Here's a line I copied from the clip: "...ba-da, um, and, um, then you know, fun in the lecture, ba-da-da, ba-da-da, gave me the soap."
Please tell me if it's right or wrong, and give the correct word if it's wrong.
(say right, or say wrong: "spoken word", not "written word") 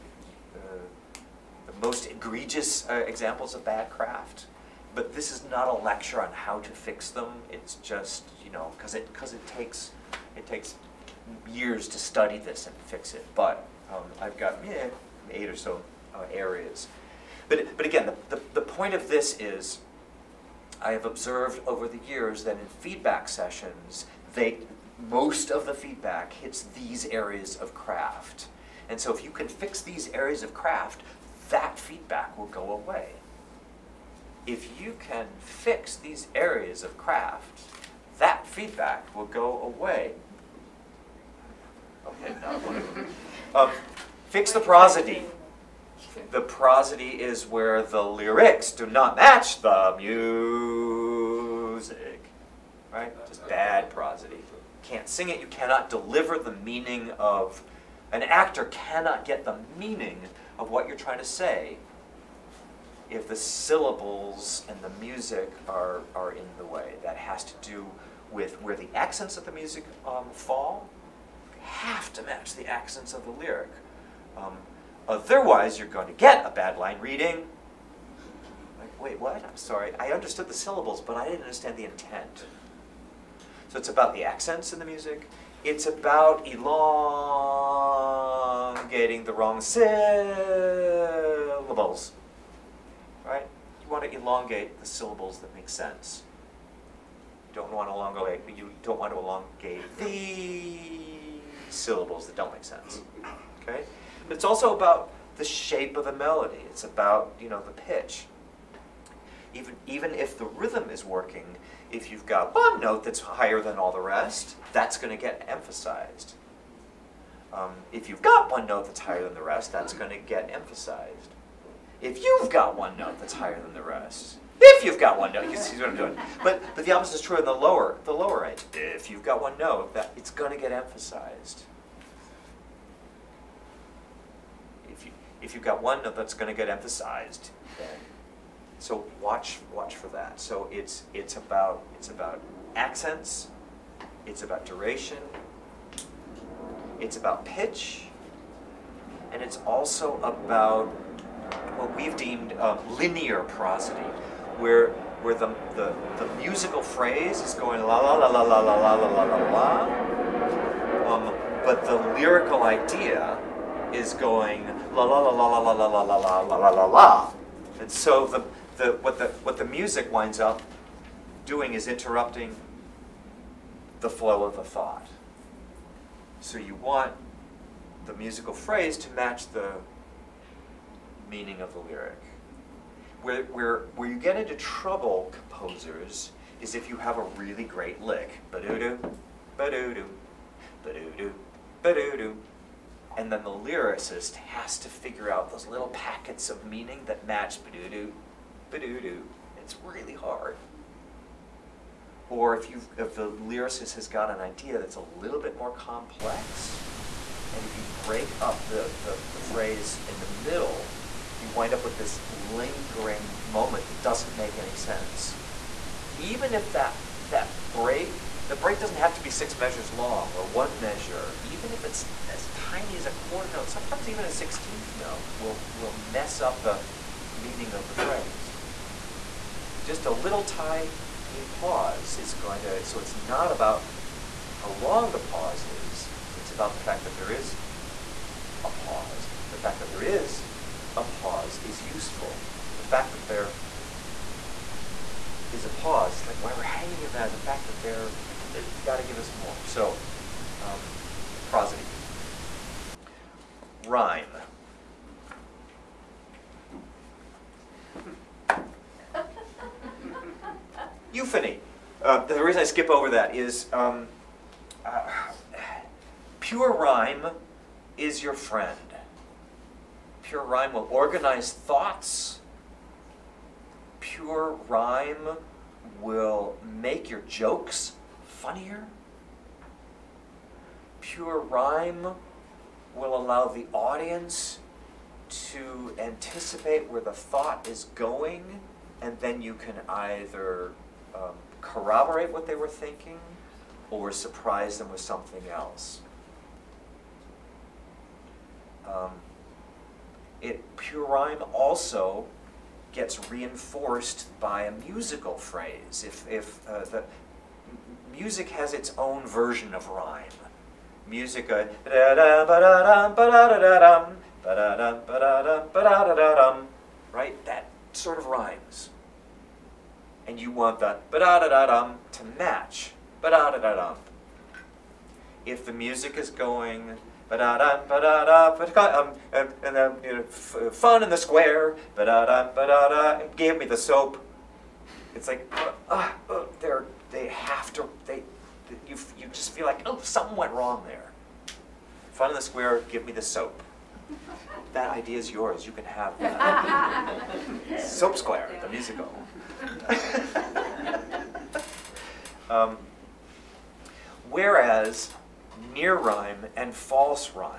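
wrong: "square", not "lecture".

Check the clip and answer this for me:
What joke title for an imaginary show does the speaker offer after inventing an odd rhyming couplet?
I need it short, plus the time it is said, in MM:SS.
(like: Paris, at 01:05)
Soap Square, at 05:47.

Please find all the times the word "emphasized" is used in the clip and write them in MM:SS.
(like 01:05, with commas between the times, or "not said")
01:55, 02:00, 02:10, 02:16.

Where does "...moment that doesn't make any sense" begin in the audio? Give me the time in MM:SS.
03:33.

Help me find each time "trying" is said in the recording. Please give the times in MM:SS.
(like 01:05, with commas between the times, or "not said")
01:00.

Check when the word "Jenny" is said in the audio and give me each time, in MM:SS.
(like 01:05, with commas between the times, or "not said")
not said.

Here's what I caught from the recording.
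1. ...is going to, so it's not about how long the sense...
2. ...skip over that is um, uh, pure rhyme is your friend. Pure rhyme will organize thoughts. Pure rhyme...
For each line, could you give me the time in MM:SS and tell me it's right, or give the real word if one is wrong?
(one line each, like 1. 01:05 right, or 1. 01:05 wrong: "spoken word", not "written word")
1. 03:52 wrong: "pause", not "sense"
2. 04:22 right.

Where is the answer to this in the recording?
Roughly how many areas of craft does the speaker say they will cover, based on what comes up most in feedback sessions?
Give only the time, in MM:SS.
00:15.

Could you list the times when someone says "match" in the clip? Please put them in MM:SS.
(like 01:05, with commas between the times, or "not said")
00:49, 01:12, 02:59, 03:17, 05:22.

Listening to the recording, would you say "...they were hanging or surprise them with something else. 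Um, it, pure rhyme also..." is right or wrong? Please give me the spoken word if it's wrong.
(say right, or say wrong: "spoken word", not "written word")
wrong: "thinking", not "hanging".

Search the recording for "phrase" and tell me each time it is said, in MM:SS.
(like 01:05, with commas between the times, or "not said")
02:36, 02:58, 03:29, 03:47, 05:05.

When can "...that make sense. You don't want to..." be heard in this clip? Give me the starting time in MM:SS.
01:35.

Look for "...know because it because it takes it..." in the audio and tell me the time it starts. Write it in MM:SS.
00:08.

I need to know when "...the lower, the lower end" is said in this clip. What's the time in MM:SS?
02:07.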